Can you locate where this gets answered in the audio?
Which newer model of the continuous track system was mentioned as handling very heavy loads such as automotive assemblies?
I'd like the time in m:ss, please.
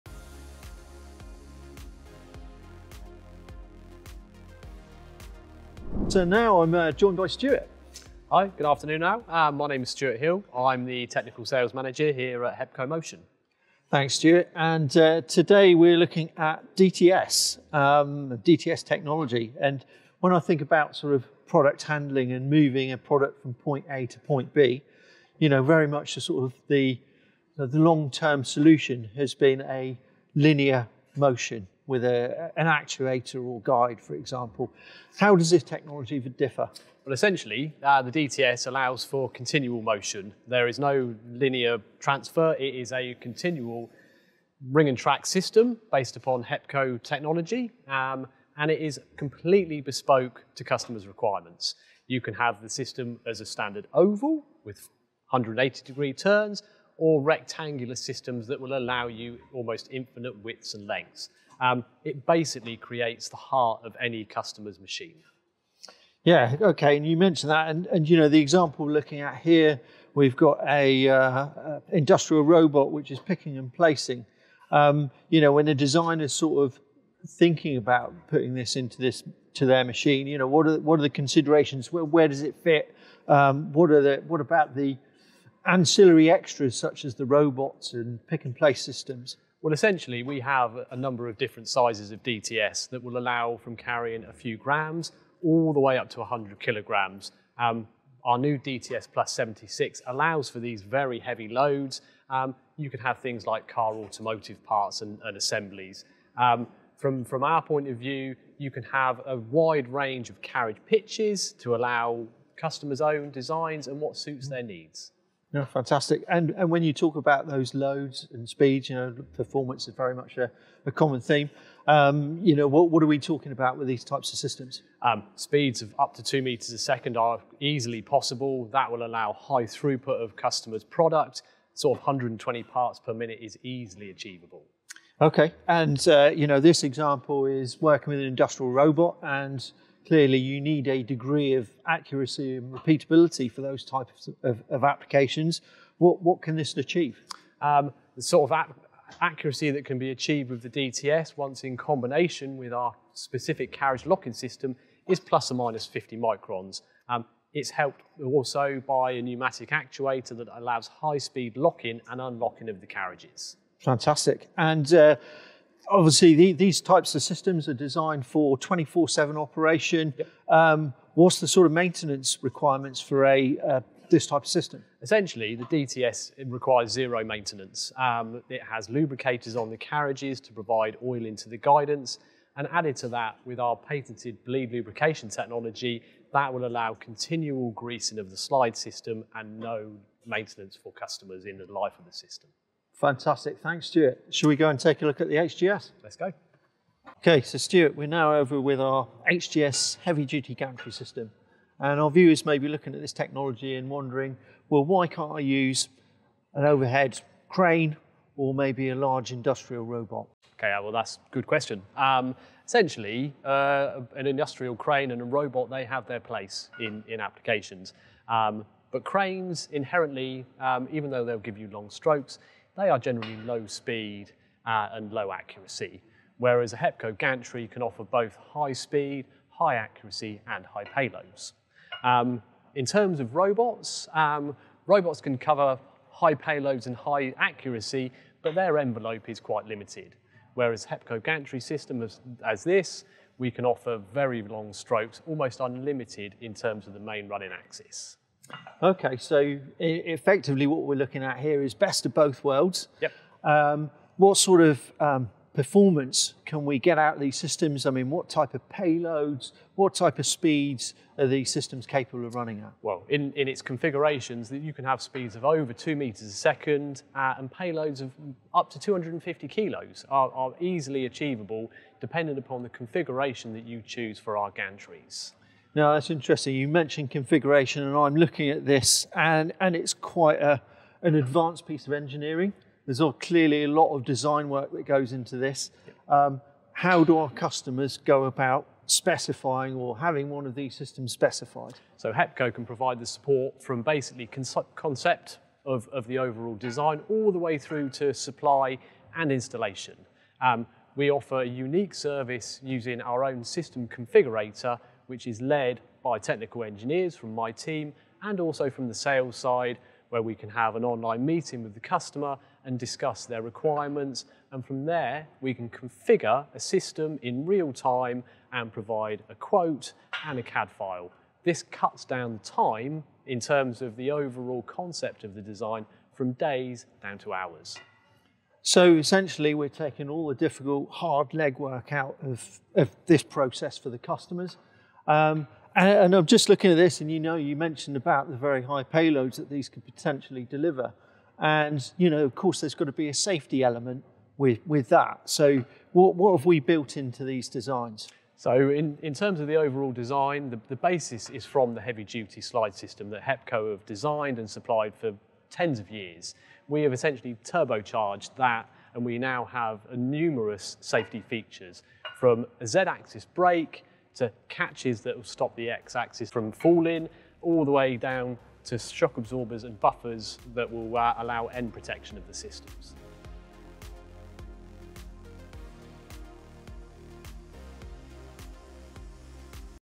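1:38.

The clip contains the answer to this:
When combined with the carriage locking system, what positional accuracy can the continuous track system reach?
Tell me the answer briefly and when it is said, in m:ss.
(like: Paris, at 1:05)
±50 microns, at 2:35.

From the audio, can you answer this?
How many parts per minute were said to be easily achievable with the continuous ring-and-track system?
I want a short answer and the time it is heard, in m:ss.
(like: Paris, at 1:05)
120, at 2:12.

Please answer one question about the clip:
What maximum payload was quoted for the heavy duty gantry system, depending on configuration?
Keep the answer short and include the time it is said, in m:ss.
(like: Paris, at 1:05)
250 kilos, at 4:28.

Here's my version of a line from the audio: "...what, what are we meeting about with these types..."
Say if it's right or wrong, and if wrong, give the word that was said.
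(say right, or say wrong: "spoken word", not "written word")
wrong: "talking", not "meeting".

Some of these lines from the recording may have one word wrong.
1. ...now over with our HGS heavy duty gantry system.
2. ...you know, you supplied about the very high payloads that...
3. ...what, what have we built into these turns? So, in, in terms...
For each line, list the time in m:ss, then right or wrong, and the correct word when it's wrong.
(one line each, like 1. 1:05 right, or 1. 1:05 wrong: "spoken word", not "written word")
1. 3:18 right
2. 5:37 wrong: "mentioned", not "supplied"
3. 5:45 wrong: "designs", not "turns".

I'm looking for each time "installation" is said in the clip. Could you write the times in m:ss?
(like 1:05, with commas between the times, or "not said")
4:59.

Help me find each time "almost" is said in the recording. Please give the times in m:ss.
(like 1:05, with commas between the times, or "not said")
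0:59, 4:05.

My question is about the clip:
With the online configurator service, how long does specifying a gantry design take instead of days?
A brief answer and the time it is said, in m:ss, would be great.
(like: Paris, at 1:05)
hours, at 5:27.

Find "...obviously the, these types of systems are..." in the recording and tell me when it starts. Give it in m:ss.
2:45.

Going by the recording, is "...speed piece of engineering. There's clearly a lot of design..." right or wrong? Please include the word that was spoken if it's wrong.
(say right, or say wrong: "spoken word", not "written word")
wrong: "advanced", not "speed".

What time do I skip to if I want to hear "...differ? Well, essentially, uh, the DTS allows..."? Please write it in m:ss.
0:36.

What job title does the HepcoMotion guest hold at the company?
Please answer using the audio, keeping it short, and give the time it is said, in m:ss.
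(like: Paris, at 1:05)
Technical Sales Manager, at 0:11.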